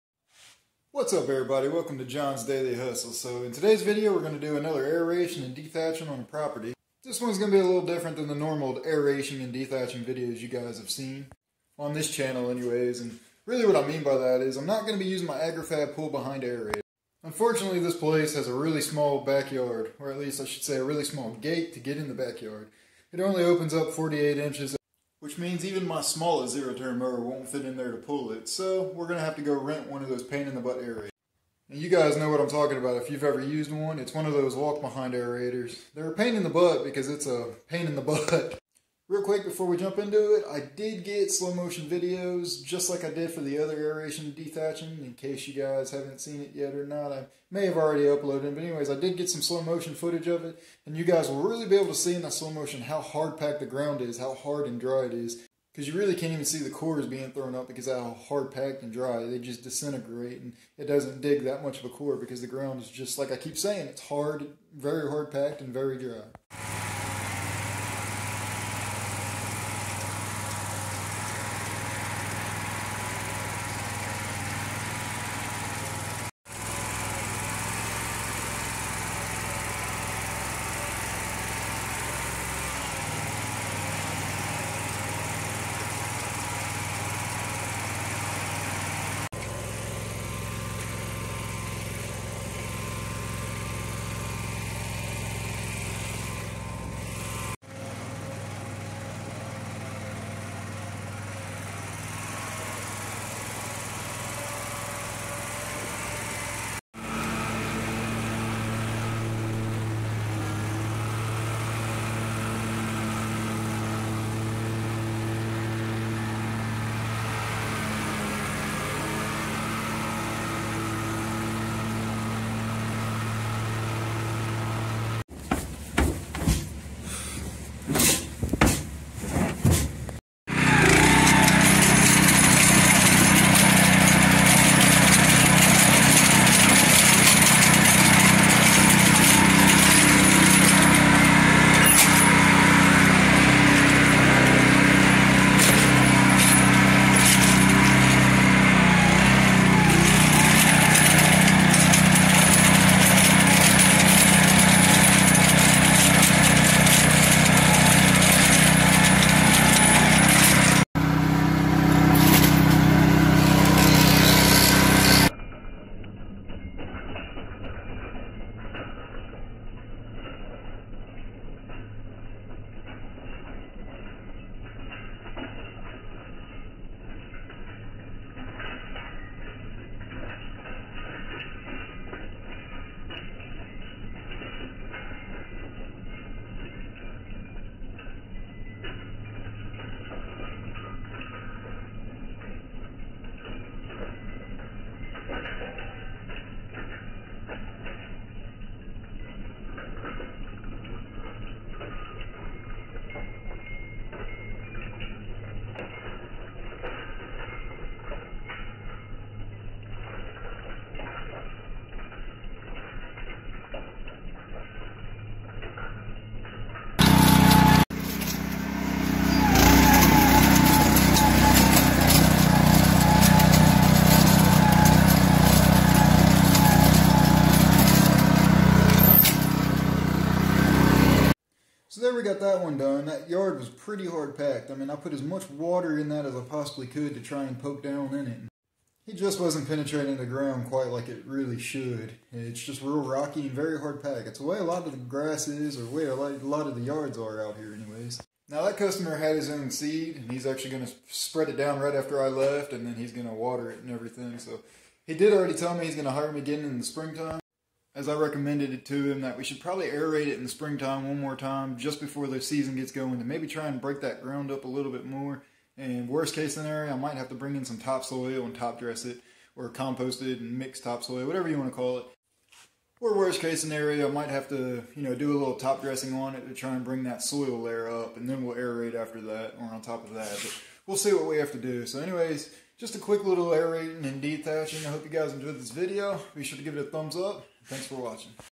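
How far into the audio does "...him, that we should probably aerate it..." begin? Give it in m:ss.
4:19.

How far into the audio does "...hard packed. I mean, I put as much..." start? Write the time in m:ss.
3:54.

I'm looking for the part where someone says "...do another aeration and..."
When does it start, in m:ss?
0:04.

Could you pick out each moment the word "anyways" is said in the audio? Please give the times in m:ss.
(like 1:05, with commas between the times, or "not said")
0:12, 0:48, 4:07, 4:41.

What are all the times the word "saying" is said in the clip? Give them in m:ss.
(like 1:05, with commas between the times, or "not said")
1:03.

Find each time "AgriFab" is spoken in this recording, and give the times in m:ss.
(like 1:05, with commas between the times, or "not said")
0:15.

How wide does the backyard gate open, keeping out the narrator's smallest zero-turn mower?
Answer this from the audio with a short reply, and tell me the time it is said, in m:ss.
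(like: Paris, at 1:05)
48 inches, at 0:23.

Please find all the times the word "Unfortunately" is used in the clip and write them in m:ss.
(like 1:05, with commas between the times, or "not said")
0:17.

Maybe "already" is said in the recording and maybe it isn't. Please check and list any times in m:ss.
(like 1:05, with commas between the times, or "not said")
0:47, 4:15.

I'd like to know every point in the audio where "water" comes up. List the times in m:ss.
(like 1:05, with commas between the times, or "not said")
3:55, 4:13.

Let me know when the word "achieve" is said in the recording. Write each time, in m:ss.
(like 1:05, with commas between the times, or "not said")
not said.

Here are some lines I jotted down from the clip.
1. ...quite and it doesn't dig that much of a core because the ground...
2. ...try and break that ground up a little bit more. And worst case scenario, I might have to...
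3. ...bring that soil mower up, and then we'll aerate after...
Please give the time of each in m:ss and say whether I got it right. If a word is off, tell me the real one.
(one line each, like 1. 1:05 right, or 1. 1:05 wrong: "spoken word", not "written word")
1. 0:59 wrong: "disintegrate", not "quite"
2. 4:23 right
3. 4:36 wrong: "layer", not "mower".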